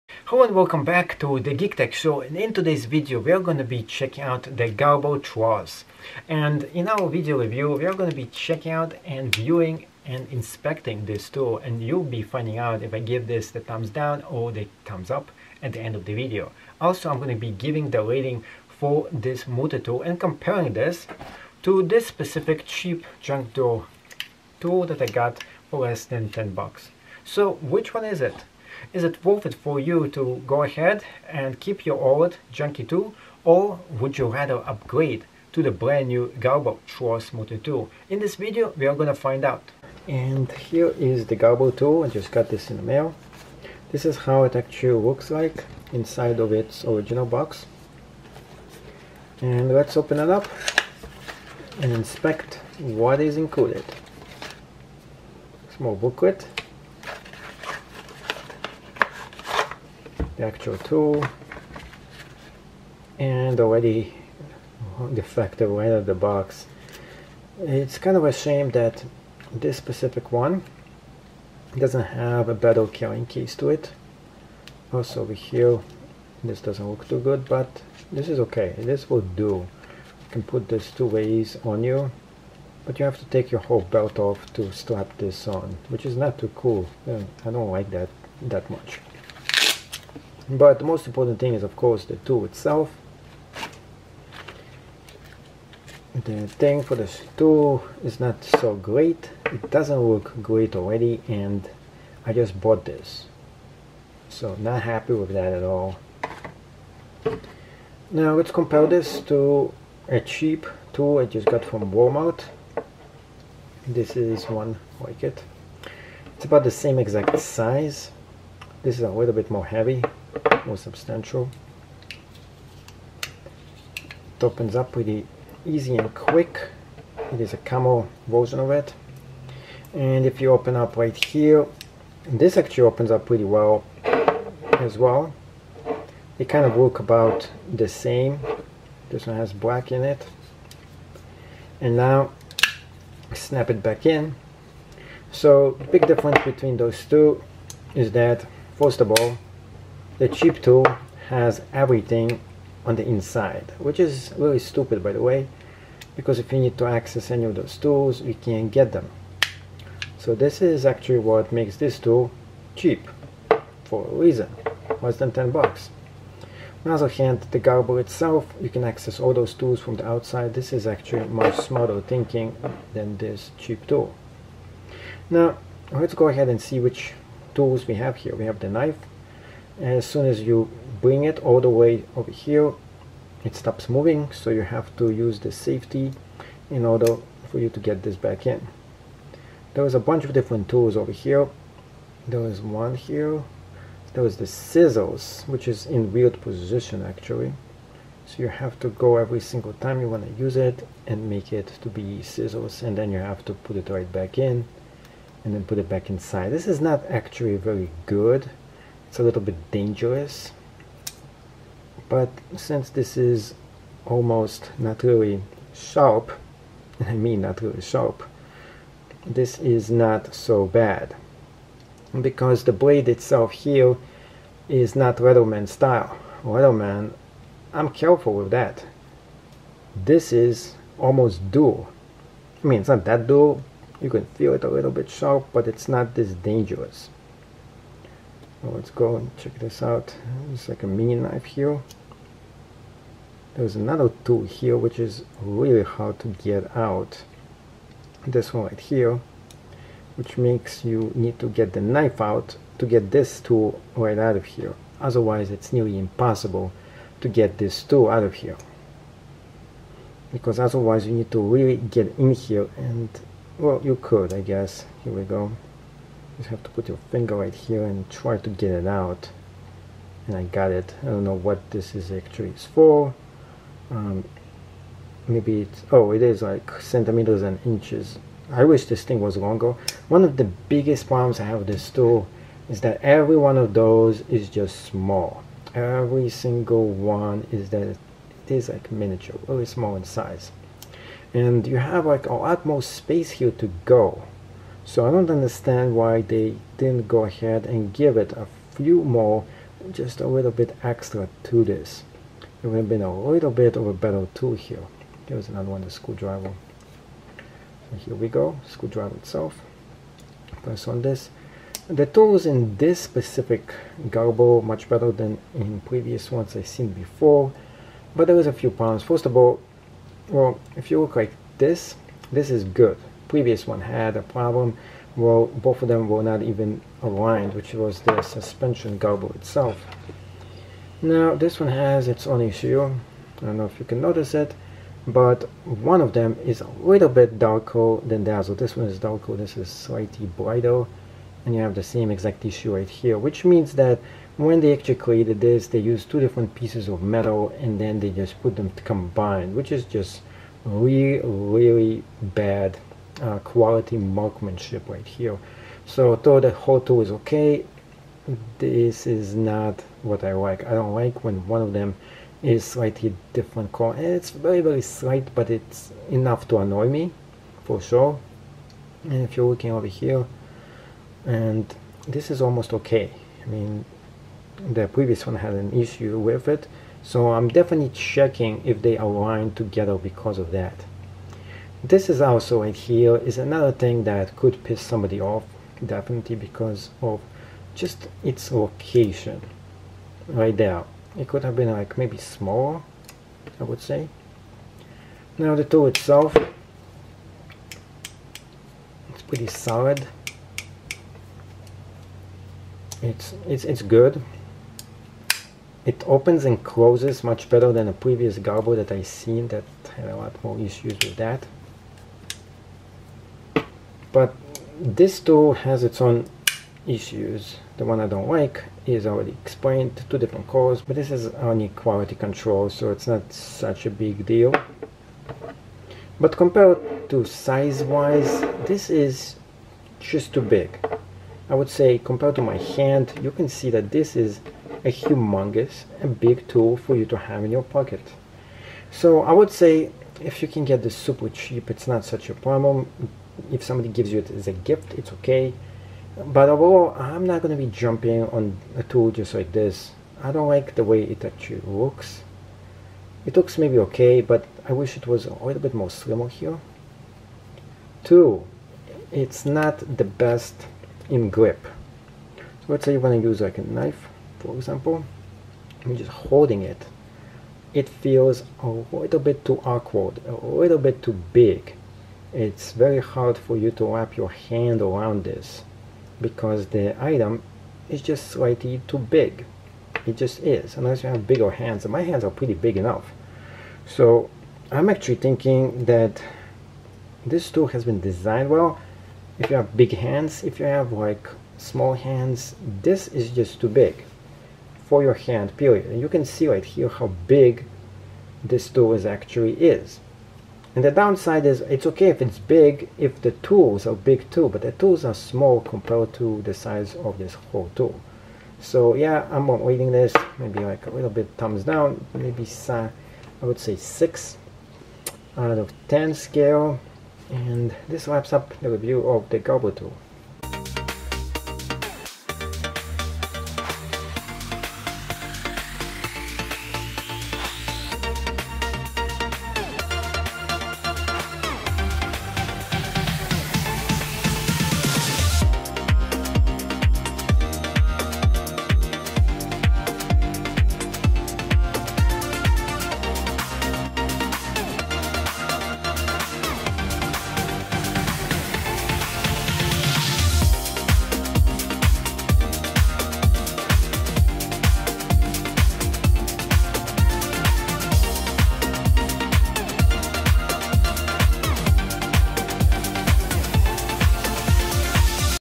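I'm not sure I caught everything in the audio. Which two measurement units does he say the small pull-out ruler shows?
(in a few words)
centimeters and inches.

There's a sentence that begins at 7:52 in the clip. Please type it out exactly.
It's very hard for you to wrap your hand around this because the item is just slightly too big.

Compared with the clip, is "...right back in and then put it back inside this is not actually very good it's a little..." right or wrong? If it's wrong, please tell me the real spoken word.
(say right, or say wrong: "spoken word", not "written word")
right.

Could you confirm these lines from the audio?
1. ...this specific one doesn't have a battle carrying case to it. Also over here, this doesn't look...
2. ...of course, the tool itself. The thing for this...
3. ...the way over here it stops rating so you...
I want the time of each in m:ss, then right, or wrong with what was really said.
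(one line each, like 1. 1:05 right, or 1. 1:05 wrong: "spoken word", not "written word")
1. 1:09 right
2. 1:31 right
3. 3:01 wrong: "moving", not "rating".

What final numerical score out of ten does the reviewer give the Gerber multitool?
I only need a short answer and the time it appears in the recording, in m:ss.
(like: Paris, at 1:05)
6, at 8:33.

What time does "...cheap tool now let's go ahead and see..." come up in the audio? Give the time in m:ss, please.
2:53.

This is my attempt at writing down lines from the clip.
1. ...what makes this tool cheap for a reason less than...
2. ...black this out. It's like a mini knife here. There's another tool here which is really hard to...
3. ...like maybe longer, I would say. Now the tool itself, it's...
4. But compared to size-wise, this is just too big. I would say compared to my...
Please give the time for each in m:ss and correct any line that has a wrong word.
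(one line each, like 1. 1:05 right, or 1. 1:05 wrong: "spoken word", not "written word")
1. 2:41 right
2. 3:59 wrong: "check", not "black"
3. 6:31 wrong: "smaller", not "longer"
4. 7:06 right.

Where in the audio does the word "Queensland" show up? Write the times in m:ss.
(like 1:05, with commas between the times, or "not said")
not said.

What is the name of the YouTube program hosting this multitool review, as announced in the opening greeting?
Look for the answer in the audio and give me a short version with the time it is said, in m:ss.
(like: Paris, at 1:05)
Geek Tech Show, at 0:01.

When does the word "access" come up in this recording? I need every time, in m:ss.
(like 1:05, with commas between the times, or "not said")
2:36, 2:48.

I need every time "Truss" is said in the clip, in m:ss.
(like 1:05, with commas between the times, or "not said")
0:05.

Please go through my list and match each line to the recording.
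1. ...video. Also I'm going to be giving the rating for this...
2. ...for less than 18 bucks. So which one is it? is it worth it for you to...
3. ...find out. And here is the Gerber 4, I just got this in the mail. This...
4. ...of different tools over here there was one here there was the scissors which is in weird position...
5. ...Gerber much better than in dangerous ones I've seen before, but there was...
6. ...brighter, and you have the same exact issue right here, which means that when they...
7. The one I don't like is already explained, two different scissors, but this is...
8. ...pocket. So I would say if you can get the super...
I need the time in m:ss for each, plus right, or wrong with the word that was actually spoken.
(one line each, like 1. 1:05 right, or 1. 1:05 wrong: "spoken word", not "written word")
1. 0:16 right
2. 0:25 wrong: "10", not "18"
3. 0:39 wrong: "2", not "4"
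4. 3:10 right
5. 5:14 wrong: "previous", not "dangerous"
6. 5:40 right
7. 6:57 wrong: "colors", not "scissors"
8. 7:17 right.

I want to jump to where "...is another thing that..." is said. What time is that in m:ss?
6:23.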